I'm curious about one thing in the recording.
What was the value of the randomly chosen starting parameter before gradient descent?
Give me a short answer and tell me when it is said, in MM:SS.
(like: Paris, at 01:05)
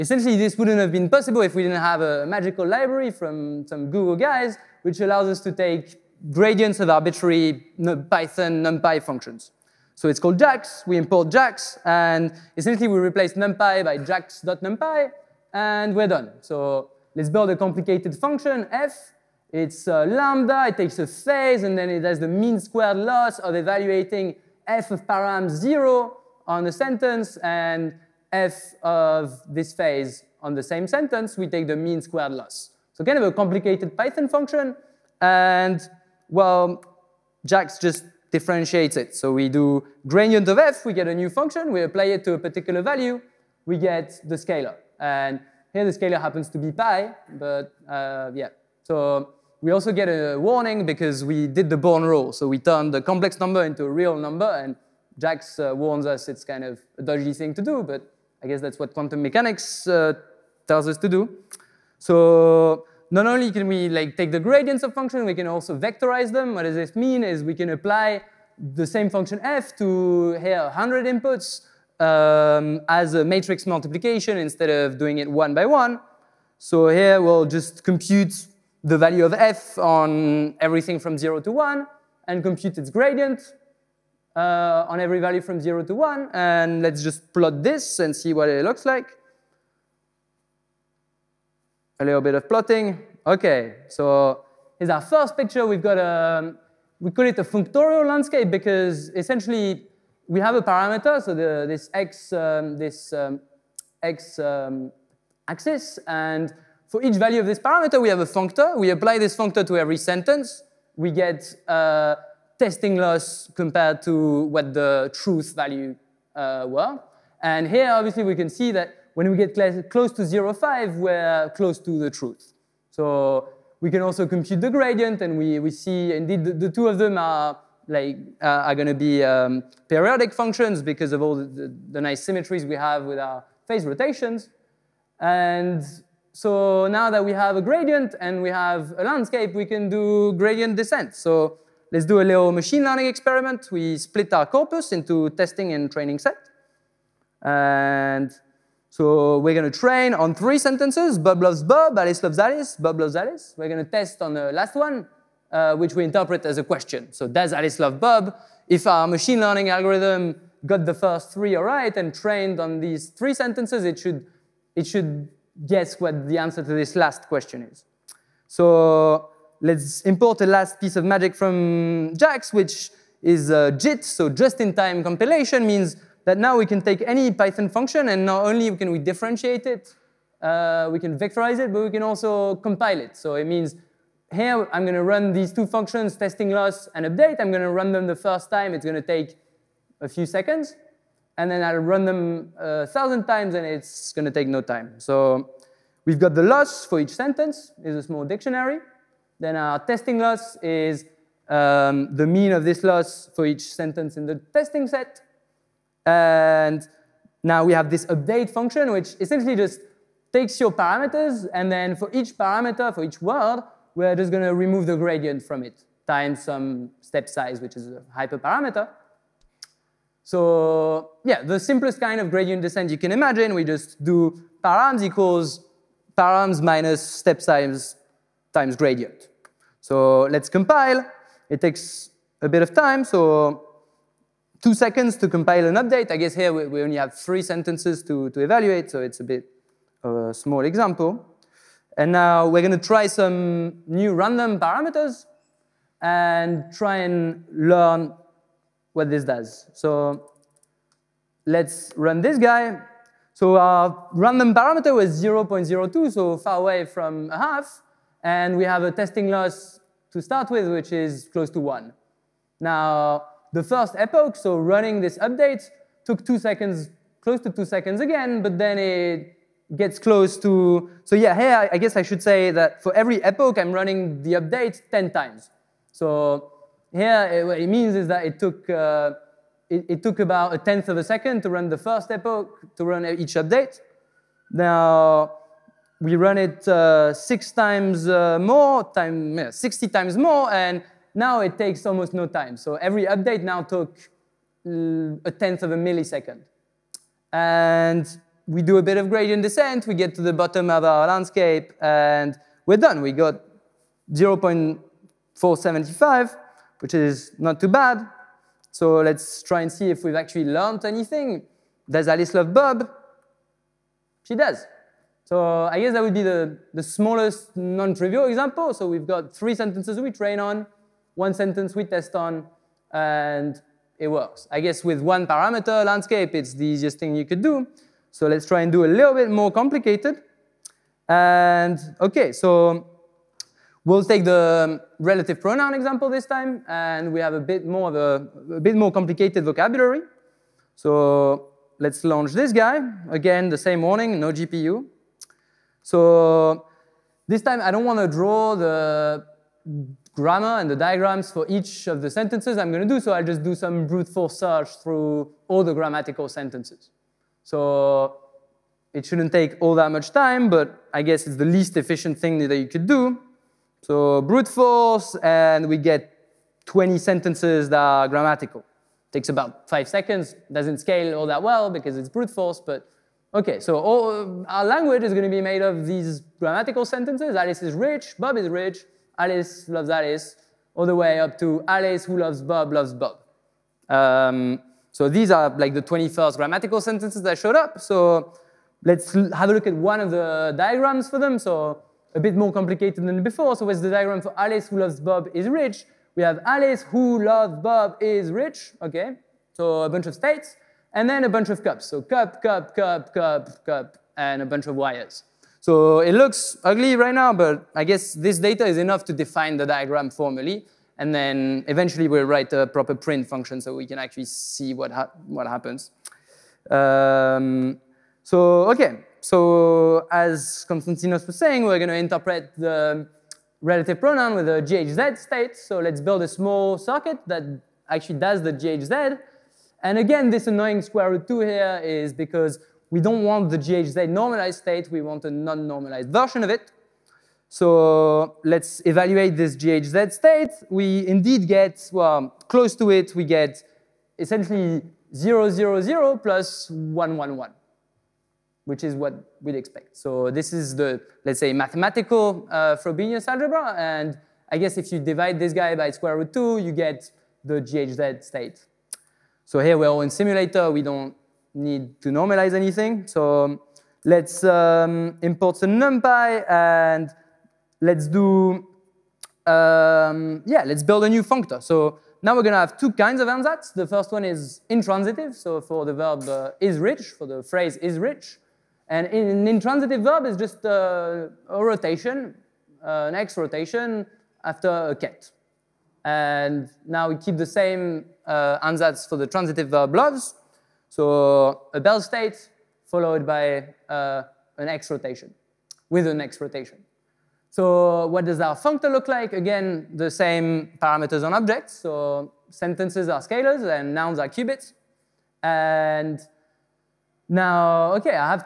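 0.02, at 04:15.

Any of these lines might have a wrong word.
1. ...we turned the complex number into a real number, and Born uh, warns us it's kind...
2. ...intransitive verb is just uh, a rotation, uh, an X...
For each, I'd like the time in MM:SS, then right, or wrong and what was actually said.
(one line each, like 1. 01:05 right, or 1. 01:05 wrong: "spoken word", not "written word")
1. 00:52 wrong: "Jax", not "Born"
2. 07:59 right.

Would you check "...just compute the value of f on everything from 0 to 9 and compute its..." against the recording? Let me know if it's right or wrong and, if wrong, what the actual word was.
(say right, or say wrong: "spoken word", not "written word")
wrong: "1", not "9".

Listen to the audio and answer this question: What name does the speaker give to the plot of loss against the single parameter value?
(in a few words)
functorial landscape.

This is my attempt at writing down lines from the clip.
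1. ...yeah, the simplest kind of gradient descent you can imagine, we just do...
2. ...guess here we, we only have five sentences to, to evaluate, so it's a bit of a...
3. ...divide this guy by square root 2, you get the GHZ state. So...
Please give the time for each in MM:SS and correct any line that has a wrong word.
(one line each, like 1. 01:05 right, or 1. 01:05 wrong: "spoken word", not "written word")
1. 03:41 right
2. 03:56 wrong: "three", not "five"
3. 07:34 right.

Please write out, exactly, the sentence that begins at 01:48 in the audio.
We apply this functor to every sentence.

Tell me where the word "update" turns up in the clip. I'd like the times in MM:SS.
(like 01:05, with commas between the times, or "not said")
03:07, 03:28, 03:55, 04:25, 04:34, 04:43, 04:53.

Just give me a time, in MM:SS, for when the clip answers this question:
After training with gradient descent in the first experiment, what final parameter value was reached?
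05:04.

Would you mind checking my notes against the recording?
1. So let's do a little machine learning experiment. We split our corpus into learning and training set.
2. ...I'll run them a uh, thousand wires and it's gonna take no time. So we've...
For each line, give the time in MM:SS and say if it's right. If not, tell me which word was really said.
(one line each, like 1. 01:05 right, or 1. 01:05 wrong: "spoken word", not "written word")
1. 02:21 wrong: "testing", not "learning"
2. 03:11 wrong: "times", not "wires".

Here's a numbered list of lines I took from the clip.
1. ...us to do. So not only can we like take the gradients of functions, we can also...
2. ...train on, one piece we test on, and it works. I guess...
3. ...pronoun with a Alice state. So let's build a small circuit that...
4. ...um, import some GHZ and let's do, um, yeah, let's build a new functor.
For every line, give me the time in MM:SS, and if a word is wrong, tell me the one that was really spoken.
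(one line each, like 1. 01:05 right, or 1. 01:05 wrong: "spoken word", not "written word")
1. 01:00 right
2. 05:20 wrong: "sentence", not "piece"
3. 07:04 wrong: "GHZ", not "Alice"
4. 07:44 wrong: "NumPy", not "GHZ".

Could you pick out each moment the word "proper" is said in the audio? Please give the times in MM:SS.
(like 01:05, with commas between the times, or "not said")
06:52.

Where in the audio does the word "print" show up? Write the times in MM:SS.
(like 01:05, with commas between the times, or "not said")
06:52.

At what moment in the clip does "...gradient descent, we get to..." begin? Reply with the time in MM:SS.
04:59.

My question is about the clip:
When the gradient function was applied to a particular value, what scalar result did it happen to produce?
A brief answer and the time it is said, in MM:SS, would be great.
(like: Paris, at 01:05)
pi, at 00:46.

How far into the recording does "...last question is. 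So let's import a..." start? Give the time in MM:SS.
02:46.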